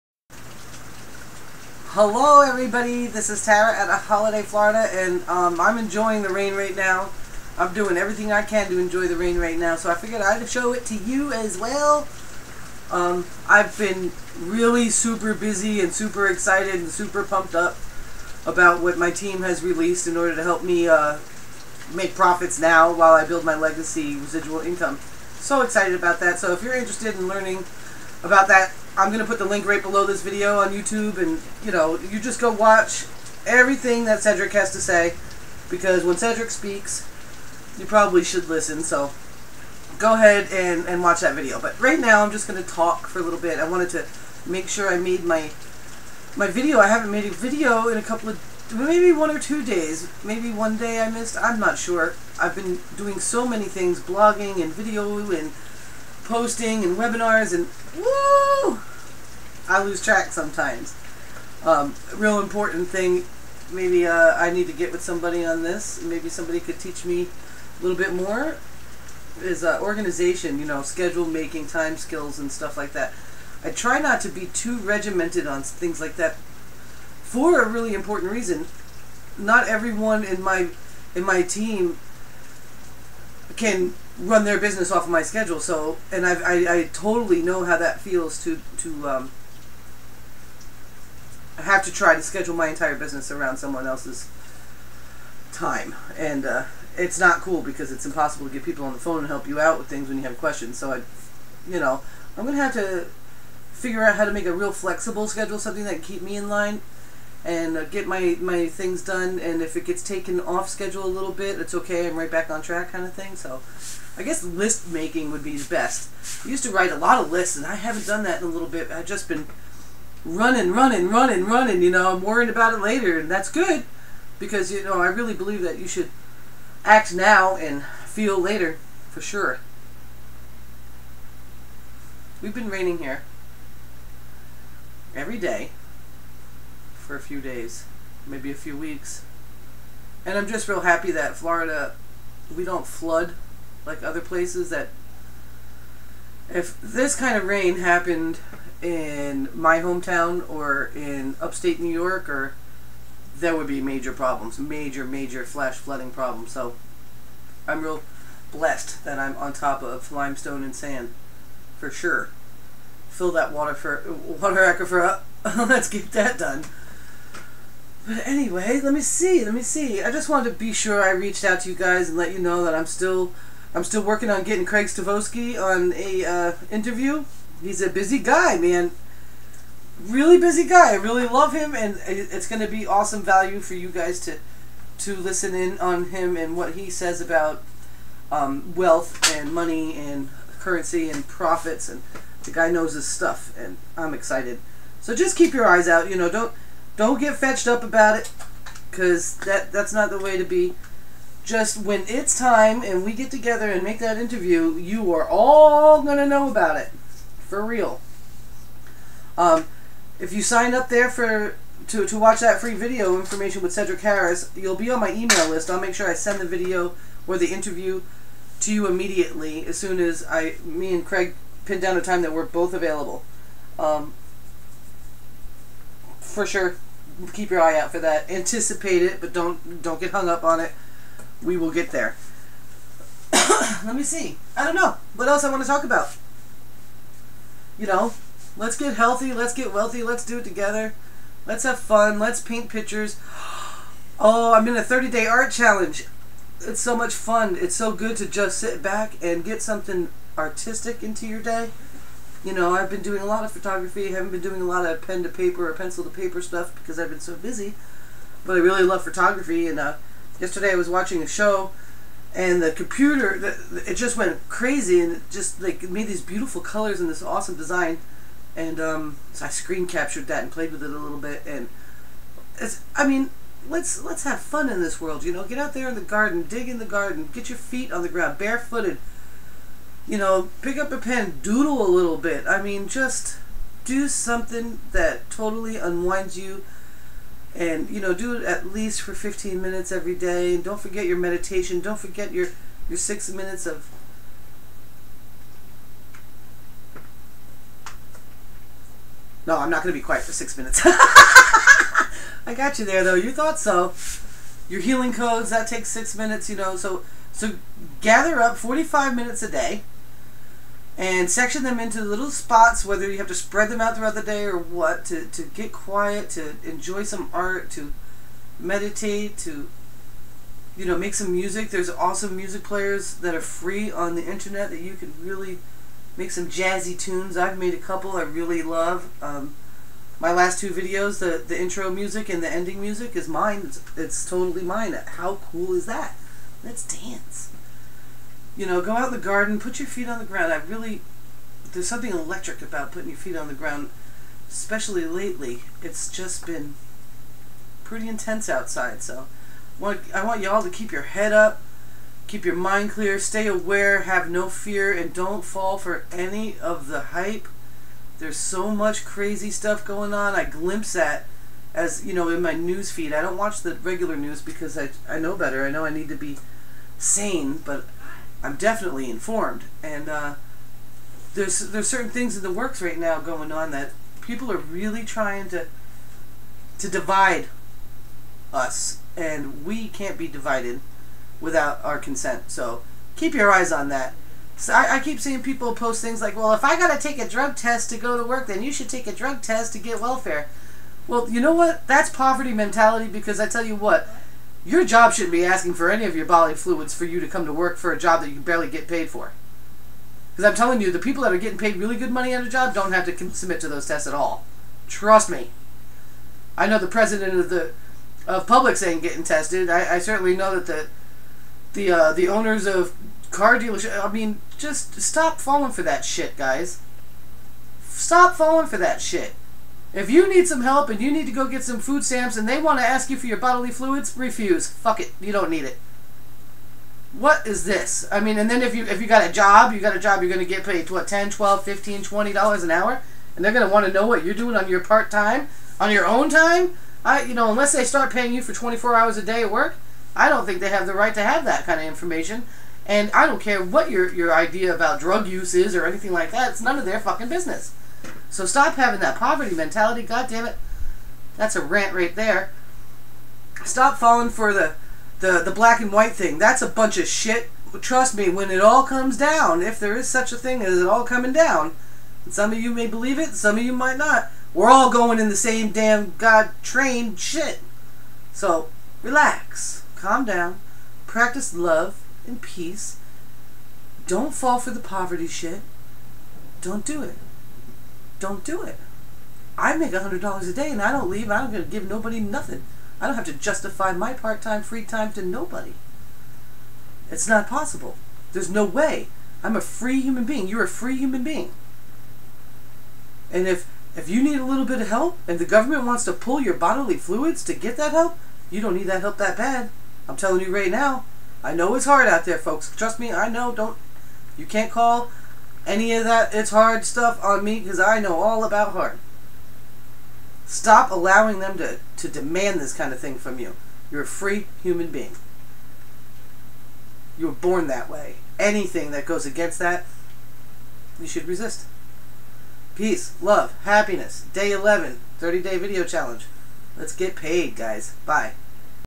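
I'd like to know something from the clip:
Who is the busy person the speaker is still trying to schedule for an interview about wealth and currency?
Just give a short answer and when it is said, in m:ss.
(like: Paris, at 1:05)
Craig Stavosky, at 2:54.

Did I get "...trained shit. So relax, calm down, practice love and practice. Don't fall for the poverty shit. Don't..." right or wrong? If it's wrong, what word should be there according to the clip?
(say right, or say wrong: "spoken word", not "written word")
wrong: "peace", not "practice".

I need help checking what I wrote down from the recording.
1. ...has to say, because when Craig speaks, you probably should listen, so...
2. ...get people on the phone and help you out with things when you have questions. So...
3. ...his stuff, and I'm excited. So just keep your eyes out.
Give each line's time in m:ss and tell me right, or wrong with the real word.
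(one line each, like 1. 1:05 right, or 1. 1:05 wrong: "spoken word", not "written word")
1. 0:34 wrong: "Cedric", not "Craig"
2. 1:38 right
3. 3:12 right.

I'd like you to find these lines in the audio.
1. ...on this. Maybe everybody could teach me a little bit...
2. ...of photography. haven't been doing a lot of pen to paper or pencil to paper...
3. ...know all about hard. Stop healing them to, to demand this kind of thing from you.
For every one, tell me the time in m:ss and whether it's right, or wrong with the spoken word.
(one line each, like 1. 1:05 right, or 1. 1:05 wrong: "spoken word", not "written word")
1. 1:05 wrong: "somebody", not "everybody"
2. 4:13 right
3. 8:27 wrong: "allowing", not "healing".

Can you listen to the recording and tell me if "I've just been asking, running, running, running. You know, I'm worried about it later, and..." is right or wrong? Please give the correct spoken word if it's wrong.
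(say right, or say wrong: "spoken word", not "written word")
wrong: "running", not "asking".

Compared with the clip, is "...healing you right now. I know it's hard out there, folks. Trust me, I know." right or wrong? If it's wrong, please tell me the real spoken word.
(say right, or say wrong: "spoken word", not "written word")
wrong: "telling", not "healing".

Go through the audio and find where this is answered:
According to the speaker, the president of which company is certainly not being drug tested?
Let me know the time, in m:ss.
6:48.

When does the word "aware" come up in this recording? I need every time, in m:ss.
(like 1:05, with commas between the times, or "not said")
5:53.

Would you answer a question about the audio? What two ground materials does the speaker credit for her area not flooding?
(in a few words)
limestone and sand.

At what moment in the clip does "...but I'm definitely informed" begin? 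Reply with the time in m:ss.
6:07.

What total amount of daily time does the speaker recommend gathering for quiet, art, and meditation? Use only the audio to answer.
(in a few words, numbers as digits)
45 minutes.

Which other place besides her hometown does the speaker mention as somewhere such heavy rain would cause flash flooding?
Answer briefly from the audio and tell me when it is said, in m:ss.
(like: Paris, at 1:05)
upstate New York, at 2:31.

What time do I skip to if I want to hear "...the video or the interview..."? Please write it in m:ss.
3:36.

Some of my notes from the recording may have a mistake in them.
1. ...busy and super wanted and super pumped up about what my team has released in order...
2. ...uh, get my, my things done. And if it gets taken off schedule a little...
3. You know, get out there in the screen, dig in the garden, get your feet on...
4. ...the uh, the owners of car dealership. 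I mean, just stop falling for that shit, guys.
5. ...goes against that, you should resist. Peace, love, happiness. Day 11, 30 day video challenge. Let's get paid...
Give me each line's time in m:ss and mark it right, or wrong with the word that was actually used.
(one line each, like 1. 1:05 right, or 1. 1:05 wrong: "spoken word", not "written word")
1. 0:15 wrong: "excited", not "wanted"
2. 1:47 right
3. 4:35 wrong: "garden", not "screen"
4. 6:51 right
5. 8:39 right.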